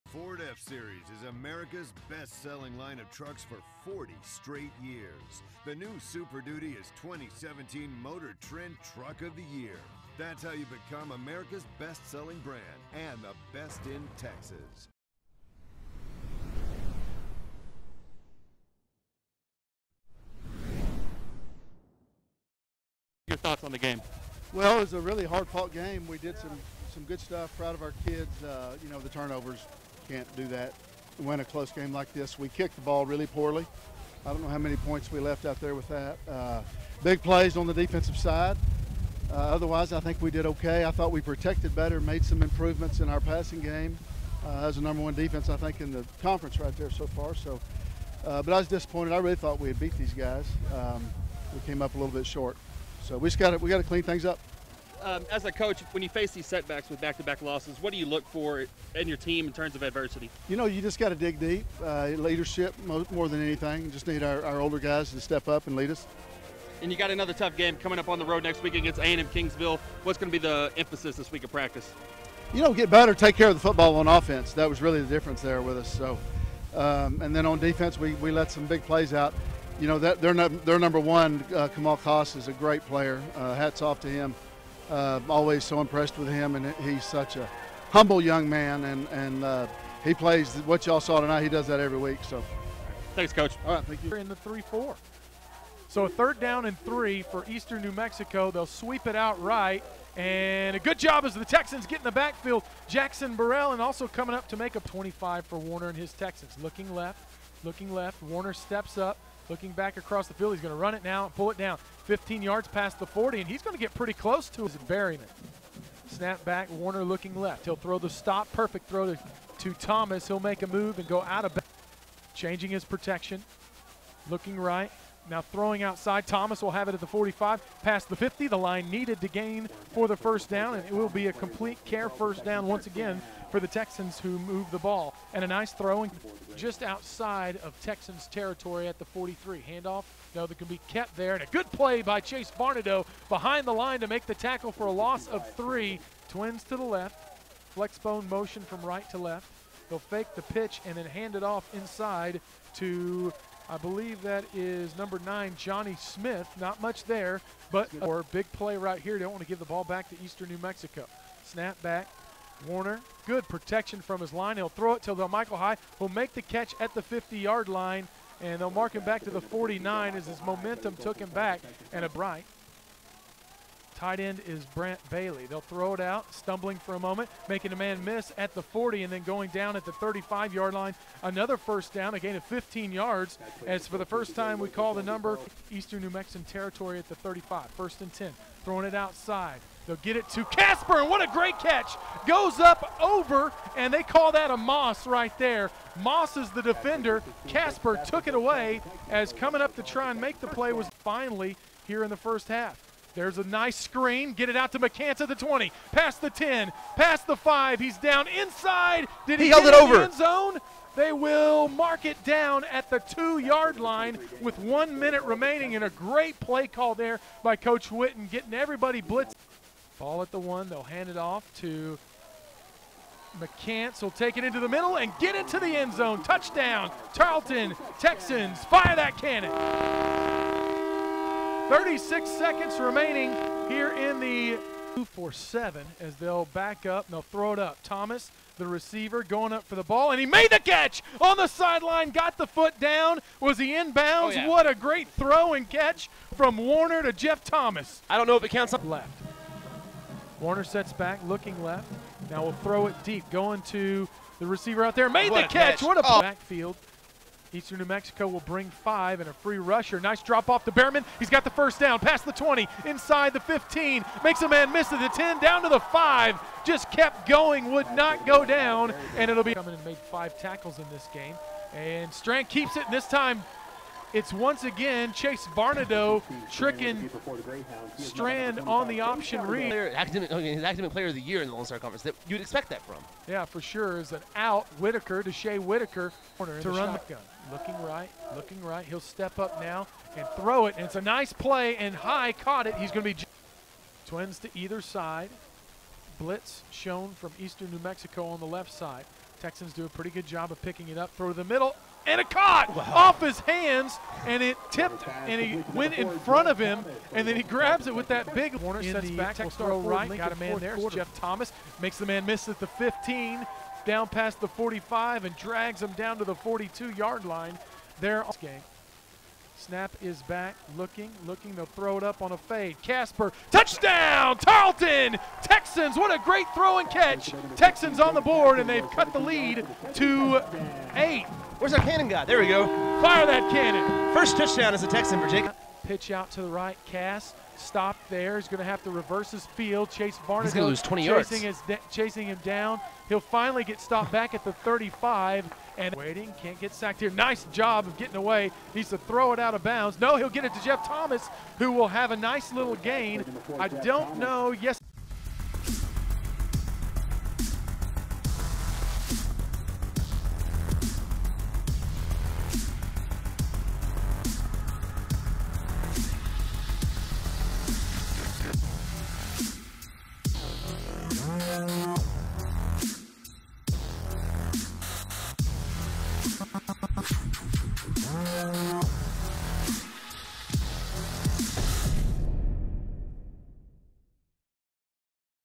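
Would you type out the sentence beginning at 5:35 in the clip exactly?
Pitch out to the right, Cass stopped there.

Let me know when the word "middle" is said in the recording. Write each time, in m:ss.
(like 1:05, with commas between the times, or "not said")
3:44, 5:01.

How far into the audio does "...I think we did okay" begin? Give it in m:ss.
0:39.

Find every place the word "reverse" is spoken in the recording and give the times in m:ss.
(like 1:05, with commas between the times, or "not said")
5:38.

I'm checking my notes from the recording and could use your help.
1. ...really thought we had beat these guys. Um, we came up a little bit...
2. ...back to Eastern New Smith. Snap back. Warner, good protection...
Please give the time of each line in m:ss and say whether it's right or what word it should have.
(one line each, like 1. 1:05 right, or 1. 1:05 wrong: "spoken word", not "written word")
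1. 0:49 right
2. 2:39 wrong: "Mexico", not "Smith".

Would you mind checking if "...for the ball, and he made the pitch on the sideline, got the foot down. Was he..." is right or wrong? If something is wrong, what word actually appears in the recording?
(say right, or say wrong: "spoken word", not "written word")
wrong: "catch", not "pitch".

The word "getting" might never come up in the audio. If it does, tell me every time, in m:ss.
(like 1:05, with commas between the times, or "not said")
3:38, 5:47.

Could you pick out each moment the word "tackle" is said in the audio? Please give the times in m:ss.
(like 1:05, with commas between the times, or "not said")
2:24, 4:30.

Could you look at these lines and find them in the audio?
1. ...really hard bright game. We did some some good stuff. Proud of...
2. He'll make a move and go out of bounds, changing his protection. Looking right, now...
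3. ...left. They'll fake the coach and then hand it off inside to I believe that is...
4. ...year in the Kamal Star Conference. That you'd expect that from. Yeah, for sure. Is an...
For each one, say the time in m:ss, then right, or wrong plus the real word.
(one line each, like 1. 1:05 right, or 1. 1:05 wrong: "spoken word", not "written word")
1. 0:24 wrong: "fought", not "bright"
2. 2:00 right
3. 2:29 wrong: "pitch", not "coach"
4. 4:41 wrong: "Lone", not "Kamal".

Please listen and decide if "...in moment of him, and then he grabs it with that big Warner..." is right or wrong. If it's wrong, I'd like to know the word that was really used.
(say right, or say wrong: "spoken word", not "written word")
wrong: "front", not "moment".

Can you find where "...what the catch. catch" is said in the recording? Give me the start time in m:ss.
4:15.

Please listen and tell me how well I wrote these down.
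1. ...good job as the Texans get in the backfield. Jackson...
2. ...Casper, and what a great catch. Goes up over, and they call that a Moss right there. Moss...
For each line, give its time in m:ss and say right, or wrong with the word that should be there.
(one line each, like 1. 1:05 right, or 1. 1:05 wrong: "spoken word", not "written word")
1. 1:40 right
2. 3:10 right.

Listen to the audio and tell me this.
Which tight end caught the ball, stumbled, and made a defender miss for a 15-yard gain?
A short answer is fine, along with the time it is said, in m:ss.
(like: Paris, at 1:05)
Brent Bailey, at 2:54.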